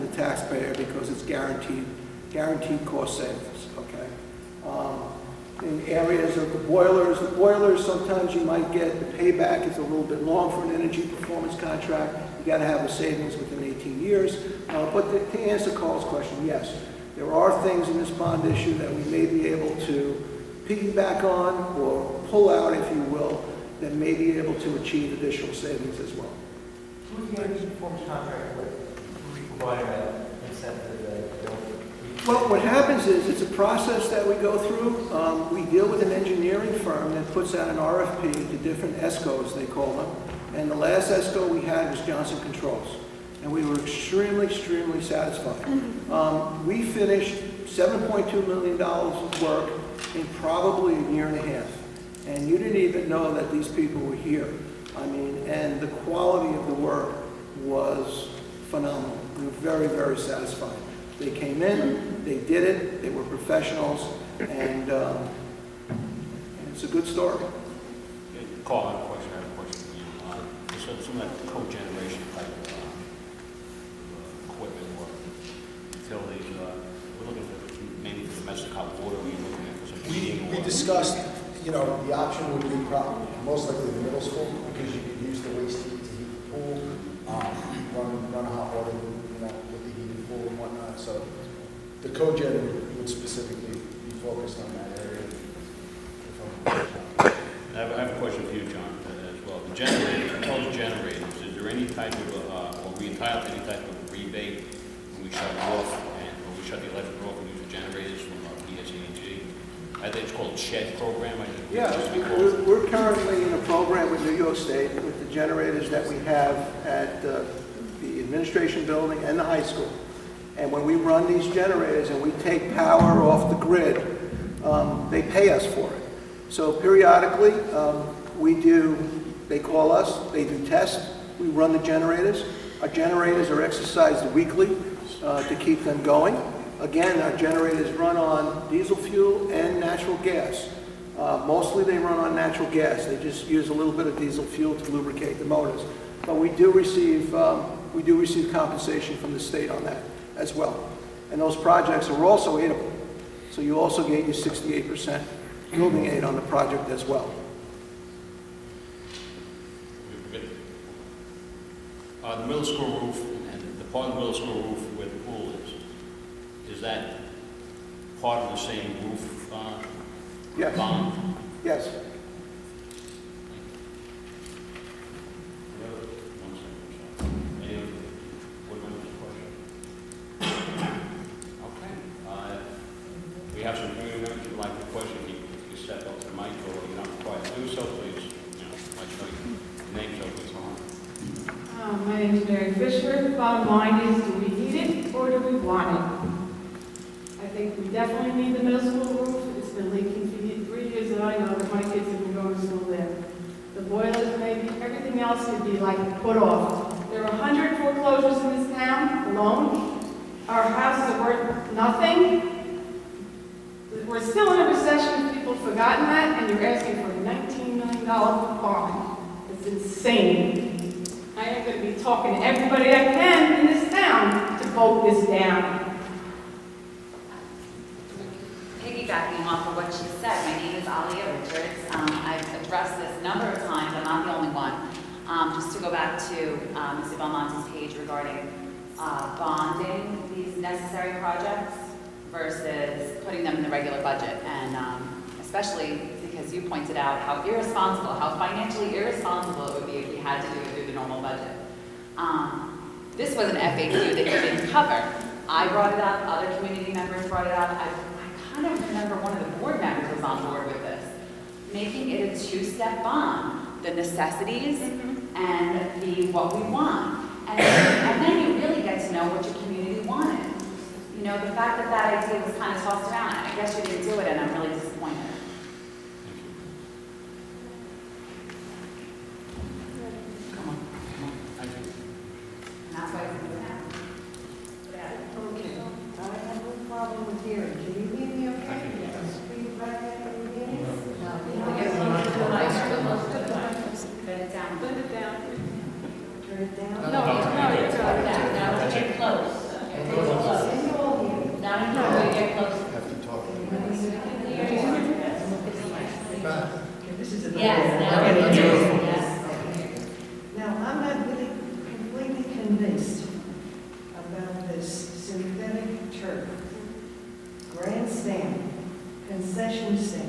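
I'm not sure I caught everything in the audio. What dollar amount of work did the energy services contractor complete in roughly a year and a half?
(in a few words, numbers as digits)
$7.2 million.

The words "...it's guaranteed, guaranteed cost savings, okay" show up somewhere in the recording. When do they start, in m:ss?
0:01.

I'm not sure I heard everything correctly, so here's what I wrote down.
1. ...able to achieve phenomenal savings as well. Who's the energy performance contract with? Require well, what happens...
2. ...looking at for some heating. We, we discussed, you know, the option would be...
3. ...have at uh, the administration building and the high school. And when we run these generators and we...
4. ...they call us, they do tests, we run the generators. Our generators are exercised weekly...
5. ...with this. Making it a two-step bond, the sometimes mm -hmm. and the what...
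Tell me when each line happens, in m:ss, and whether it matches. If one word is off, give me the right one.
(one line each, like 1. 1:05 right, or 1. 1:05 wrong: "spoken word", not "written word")
1. 0:24 wrong: "additional", not "phenomenal"
2. 1:19 right
3. 1:56 right
4. 2:09 right
5. 4:20 wrong: "necessities", not "sometimes".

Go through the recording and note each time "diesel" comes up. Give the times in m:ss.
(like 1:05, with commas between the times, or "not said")
2:18, 2:24.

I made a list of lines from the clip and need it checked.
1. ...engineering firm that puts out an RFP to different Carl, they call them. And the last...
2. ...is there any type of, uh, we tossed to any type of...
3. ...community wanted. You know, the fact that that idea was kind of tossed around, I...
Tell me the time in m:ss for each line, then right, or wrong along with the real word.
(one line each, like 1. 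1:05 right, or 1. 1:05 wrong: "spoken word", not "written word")
1. 0:36 wrong: "ESCOs", not "Carl"
2. 1:41 wrong: "entitled", not "tossed"
3. 4:29 right.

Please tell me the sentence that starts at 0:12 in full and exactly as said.
You got to have the savings within 18 years.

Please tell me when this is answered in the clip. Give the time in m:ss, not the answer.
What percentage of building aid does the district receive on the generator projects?
2:34.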